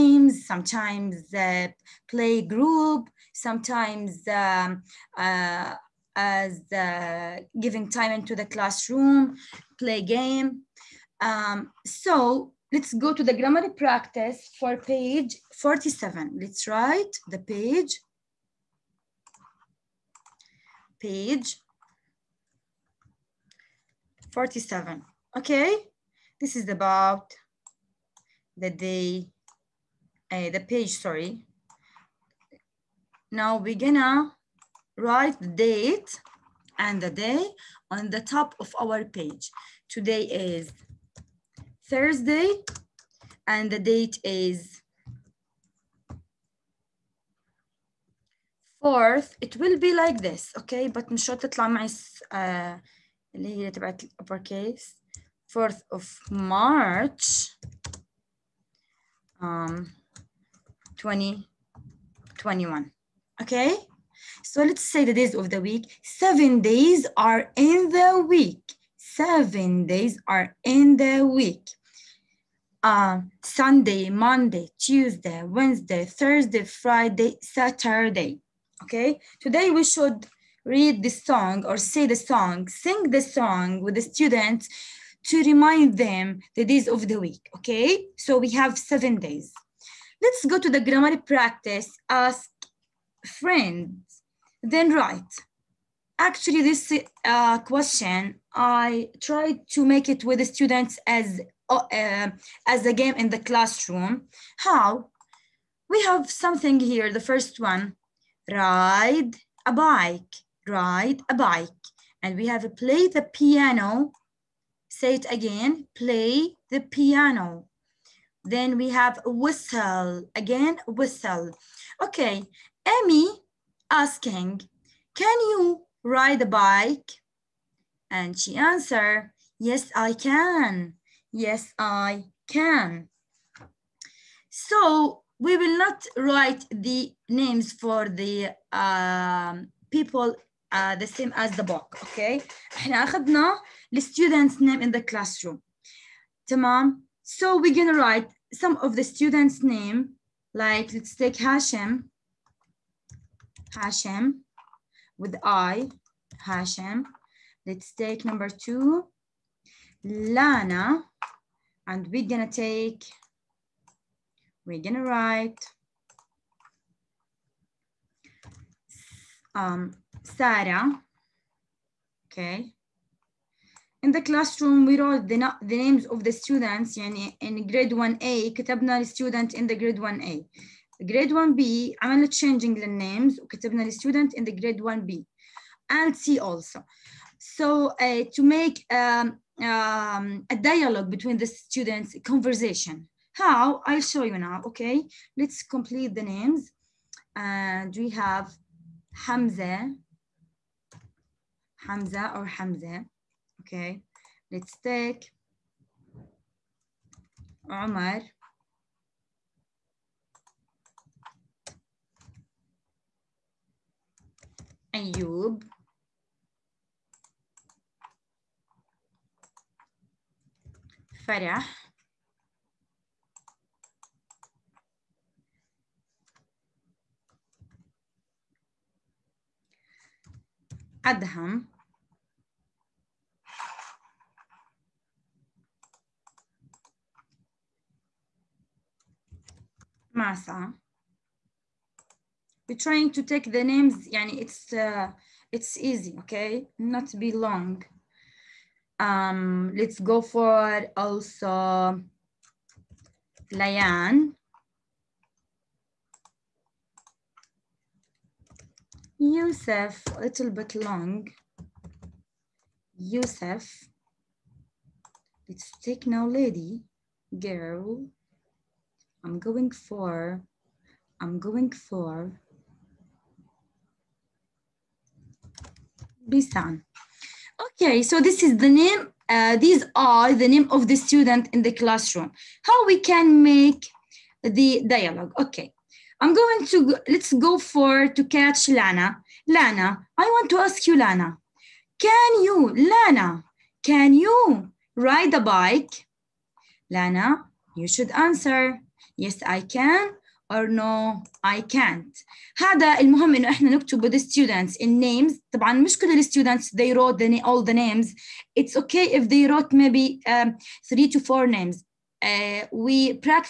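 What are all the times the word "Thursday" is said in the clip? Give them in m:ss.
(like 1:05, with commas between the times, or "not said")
0:41, 1:16.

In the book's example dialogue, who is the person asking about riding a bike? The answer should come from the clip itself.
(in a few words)
Emmy.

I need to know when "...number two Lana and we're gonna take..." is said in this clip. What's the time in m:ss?
2:38.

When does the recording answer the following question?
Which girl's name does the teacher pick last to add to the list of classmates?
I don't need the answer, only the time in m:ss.
4:36.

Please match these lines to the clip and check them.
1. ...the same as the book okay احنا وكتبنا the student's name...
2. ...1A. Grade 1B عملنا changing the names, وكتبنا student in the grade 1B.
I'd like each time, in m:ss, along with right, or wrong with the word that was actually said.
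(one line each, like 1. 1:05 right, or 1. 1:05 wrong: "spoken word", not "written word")
1. 2:20 wrong: "اخذنا", not "وكتبنا"
2. 2:59 right.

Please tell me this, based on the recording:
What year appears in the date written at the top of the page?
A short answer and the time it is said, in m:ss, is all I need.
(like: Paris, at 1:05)
2021, at 1:00.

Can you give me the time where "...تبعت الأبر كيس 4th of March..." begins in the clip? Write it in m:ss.
0:53.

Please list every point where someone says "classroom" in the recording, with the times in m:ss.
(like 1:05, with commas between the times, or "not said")
0:08, 1:43, 2:25, 2:54, 4:41.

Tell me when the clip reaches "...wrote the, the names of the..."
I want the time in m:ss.
2:54.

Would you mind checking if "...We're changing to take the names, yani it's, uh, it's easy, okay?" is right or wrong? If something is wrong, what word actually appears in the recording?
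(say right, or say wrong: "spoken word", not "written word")
wrong: "trying", not "changing".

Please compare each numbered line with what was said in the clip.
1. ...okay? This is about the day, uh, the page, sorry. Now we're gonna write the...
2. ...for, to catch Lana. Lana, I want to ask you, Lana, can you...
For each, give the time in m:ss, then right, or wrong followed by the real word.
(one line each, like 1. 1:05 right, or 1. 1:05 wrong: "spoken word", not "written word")
1. 0:25 right
2. 4:47 right.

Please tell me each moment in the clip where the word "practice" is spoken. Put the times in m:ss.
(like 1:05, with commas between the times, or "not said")
0:13, 1:31.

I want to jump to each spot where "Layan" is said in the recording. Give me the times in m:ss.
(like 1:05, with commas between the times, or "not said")
4:13.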